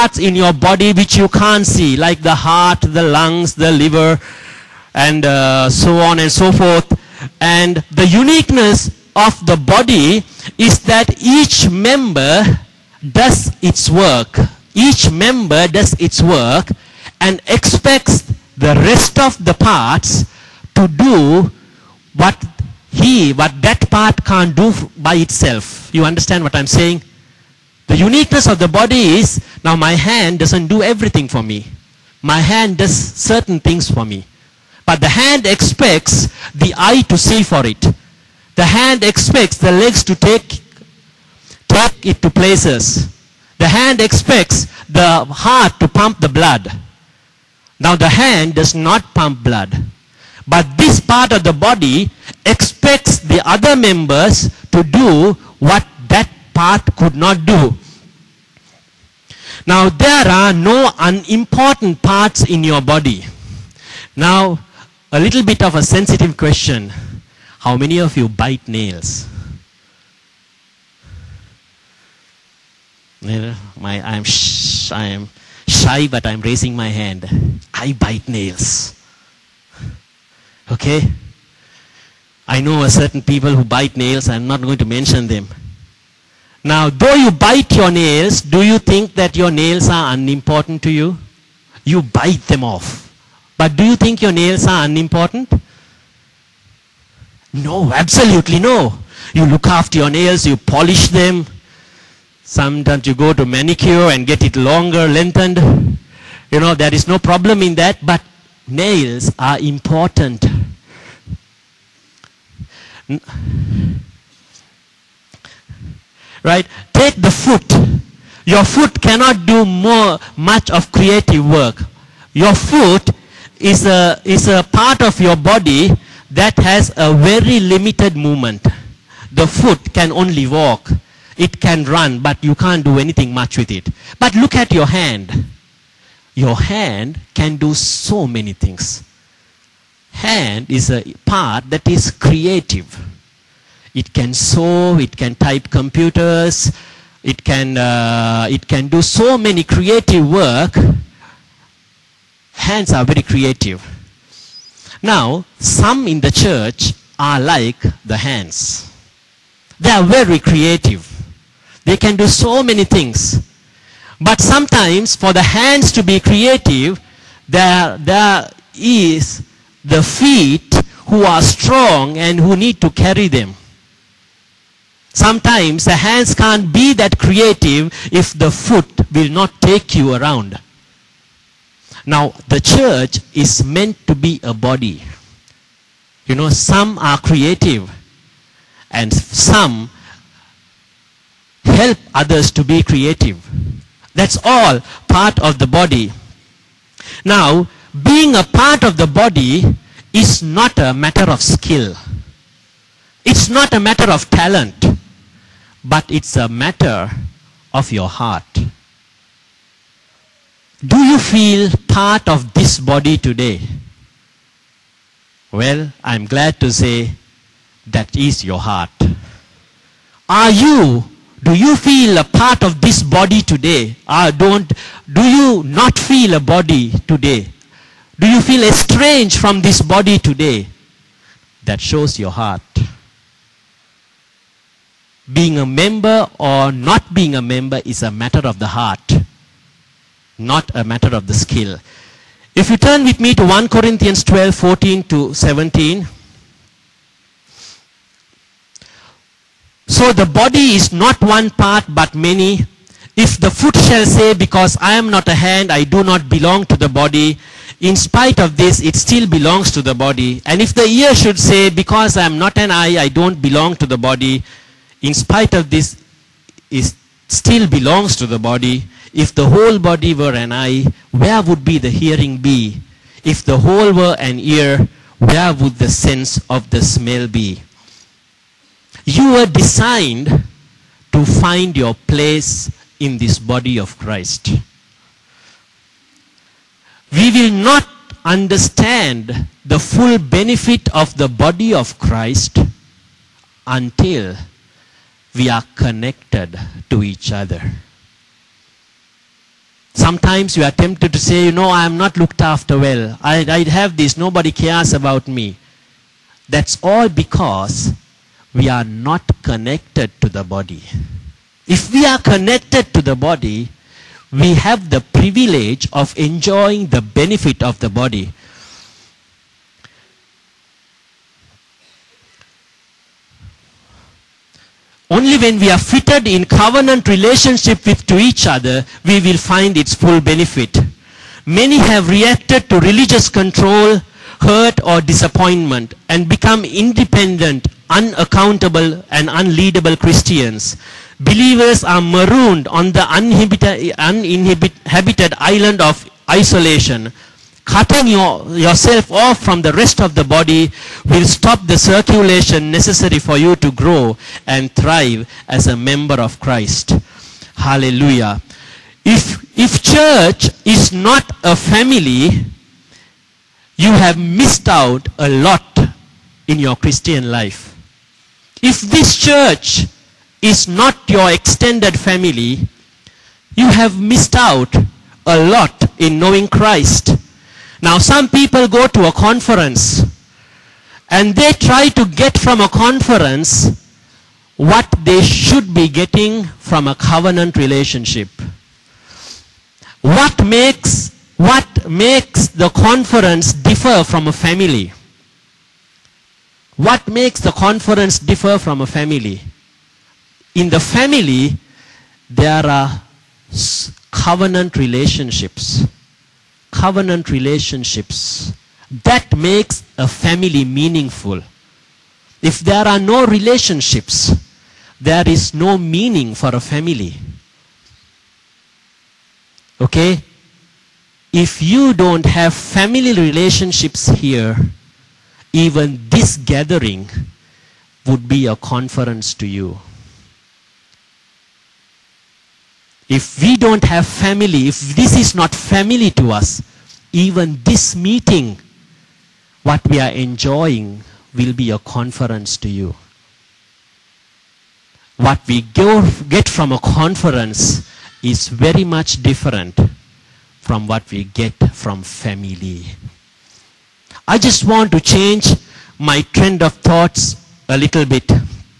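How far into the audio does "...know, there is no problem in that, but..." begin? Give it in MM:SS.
01:46.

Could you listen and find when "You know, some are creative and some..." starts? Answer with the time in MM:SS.
03:06.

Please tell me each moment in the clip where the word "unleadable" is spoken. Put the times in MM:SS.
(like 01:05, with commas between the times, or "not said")
05:39.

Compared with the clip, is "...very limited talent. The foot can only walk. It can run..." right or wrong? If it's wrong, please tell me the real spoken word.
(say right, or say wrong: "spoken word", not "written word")
wrong: "movement", not "talent".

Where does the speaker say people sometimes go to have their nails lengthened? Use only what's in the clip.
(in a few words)
Manicure.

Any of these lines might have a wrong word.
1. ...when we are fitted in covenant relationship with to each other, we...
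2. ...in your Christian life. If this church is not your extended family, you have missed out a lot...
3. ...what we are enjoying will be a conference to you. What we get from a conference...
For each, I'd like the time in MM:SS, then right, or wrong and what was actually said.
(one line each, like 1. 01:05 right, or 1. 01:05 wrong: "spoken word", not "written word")
1. 05:25 right
2. 06:06 right
3. 07:19 right.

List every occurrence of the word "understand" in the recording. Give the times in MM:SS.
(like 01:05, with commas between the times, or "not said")
00:26, 04:48.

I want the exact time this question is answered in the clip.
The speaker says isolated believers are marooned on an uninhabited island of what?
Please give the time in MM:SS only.
05:46.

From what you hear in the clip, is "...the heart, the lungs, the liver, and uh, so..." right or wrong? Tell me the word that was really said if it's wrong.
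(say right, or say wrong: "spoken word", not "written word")
right.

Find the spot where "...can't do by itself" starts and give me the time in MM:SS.
00:24.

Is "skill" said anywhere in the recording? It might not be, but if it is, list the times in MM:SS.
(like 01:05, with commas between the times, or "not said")
03:21, 04:01.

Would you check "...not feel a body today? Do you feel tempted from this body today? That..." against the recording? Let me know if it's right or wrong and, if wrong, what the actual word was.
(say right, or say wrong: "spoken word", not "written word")
wrong: "estranged", not "tempted".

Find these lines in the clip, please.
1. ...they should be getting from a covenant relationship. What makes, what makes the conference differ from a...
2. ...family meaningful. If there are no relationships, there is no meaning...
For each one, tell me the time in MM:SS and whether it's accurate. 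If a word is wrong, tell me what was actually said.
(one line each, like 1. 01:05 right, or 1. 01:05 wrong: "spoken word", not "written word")
1. 06:25 right
2. 06:50 right.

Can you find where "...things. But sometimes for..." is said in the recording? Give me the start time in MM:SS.
02:42.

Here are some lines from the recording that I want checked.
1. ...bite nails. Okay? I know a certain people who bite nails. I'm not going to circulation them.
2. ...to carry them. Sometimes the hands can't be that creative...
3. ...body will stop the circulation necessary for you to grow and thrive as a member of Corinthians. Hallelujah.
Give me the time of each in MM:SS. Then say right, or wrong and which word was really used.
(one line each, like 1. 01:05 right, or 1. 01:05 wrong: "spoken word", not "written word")
1. 01:17 wrong: "mention", not "circulation"
2. 02:52 right
3. 05:50 wrong: "Christ", not "Corinthians".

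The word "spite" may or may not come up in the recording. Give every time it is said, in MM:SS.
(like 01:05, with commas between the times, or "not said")
04:17, 04:25.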